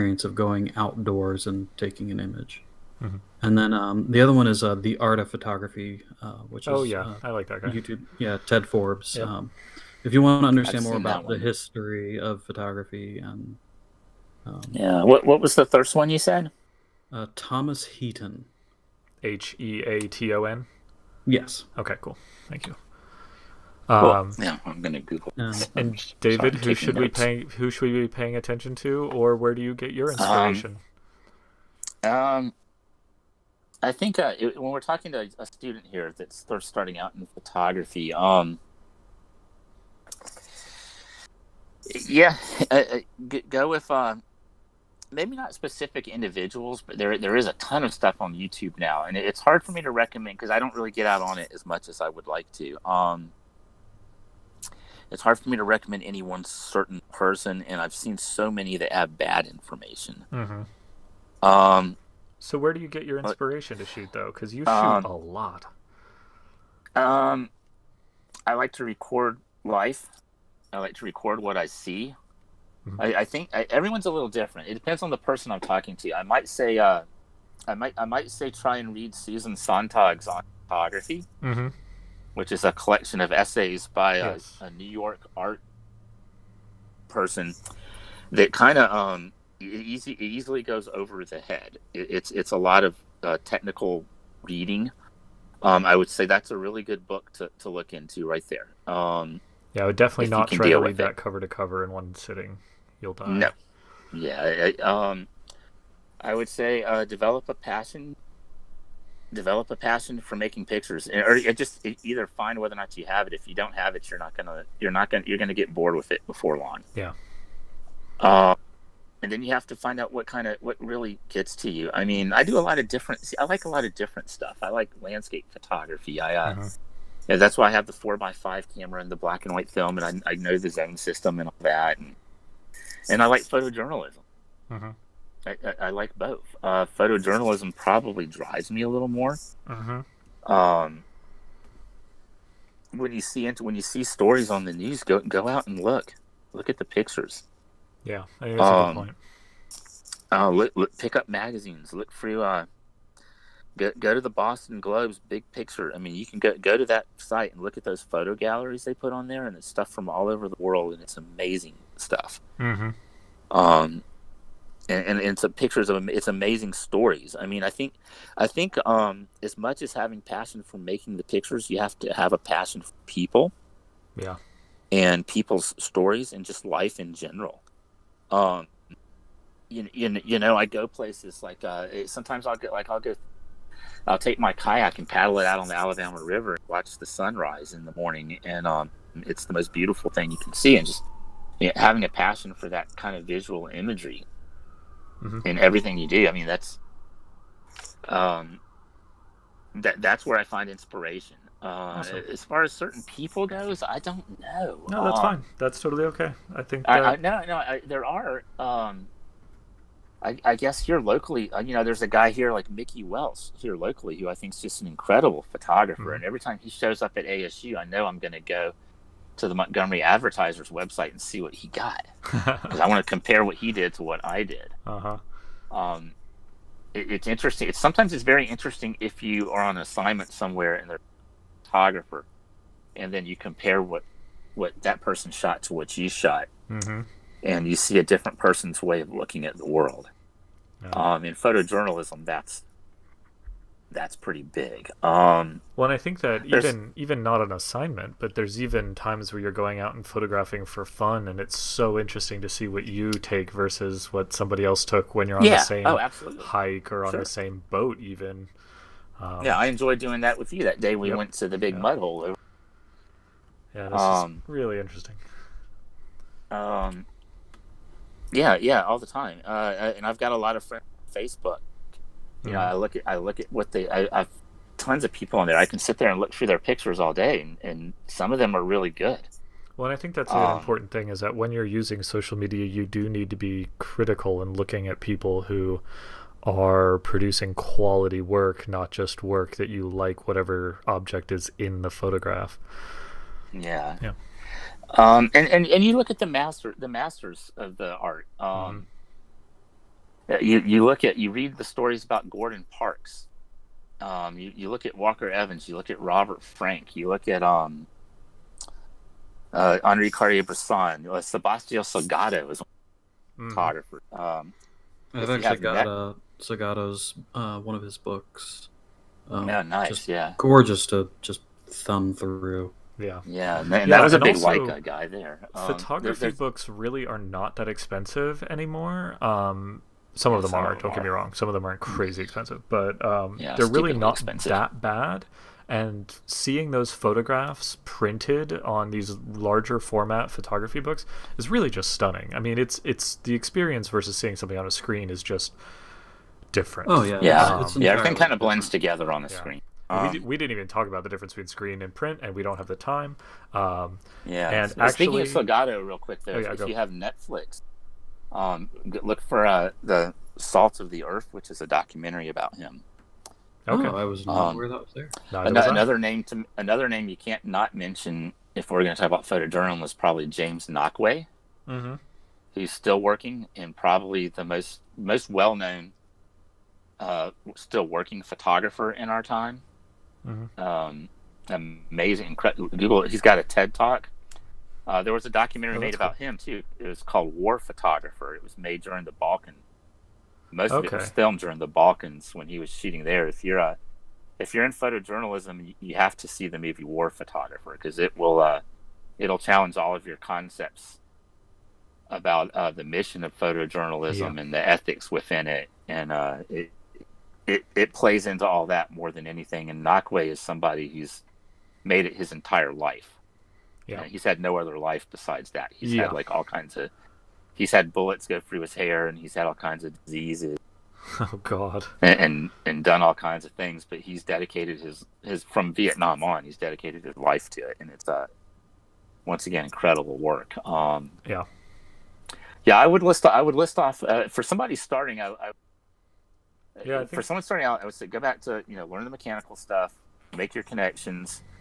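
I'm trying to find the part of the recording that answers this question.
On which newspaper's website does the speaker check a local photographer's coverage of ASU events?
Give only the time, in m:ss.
3:39.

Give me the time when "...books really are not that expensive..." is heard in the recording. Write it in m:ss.
5:26.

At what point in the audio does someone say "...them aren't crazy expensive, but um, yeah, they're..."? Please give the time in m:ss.
5:31.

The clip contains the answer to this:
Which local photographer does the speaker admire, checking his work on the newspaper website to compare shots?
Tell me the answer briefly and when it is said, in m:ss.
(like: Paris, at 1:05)
Mickey Welsh, at 3:32.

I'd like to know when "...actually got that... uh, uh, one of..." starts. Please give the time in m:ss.
5:15.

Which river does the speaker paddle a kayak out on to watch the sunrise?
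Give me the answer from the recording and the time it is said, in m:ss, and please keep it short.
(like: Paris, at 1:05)
Alabama River, at 3:05.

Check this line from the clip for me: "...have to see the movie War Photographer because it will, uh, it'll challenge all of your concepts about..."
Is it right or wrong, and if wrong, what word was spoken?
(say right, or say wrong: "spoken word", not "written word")
right.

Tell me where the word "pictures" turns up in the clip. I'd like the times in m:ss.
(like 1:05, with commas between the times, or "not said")
1:50, 2:26, 2:35, 2:45, 2:51, 4:36.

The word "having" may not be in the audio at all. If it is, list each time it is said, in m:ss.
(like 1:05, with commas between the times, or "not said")
2:49, 3:11.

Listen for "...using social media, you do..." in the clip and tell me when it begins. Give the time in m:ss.
4:41.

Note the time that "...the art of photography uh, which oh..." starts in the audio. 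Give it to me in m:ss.
0:04.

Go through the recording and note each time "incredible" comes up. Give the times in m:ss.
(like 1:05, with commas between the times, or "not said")
3:34, 6:22, 7:09.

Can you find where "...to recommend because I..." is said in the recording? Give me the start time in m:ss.
0:49.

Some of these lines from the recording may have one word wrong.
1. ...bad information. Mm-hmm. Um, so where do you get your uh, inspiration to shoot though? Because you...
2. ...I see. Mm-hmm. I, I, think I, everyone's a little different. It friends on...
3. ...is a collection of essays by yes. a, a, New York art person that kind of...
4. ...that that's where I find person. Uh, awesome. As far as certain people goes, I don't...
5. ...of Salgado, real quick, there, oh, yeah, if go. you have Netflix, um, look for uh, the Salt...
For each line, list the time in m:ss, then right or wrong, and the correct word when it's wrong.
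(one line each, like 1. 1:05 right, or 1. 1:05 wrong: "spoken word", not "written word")
1. 0:59 right
2. 1:11 wrong: "depends", not "friends"
3. 1:22 right
4. 3:19 wrong: "inspiration", not "person"
5. 5:55 right.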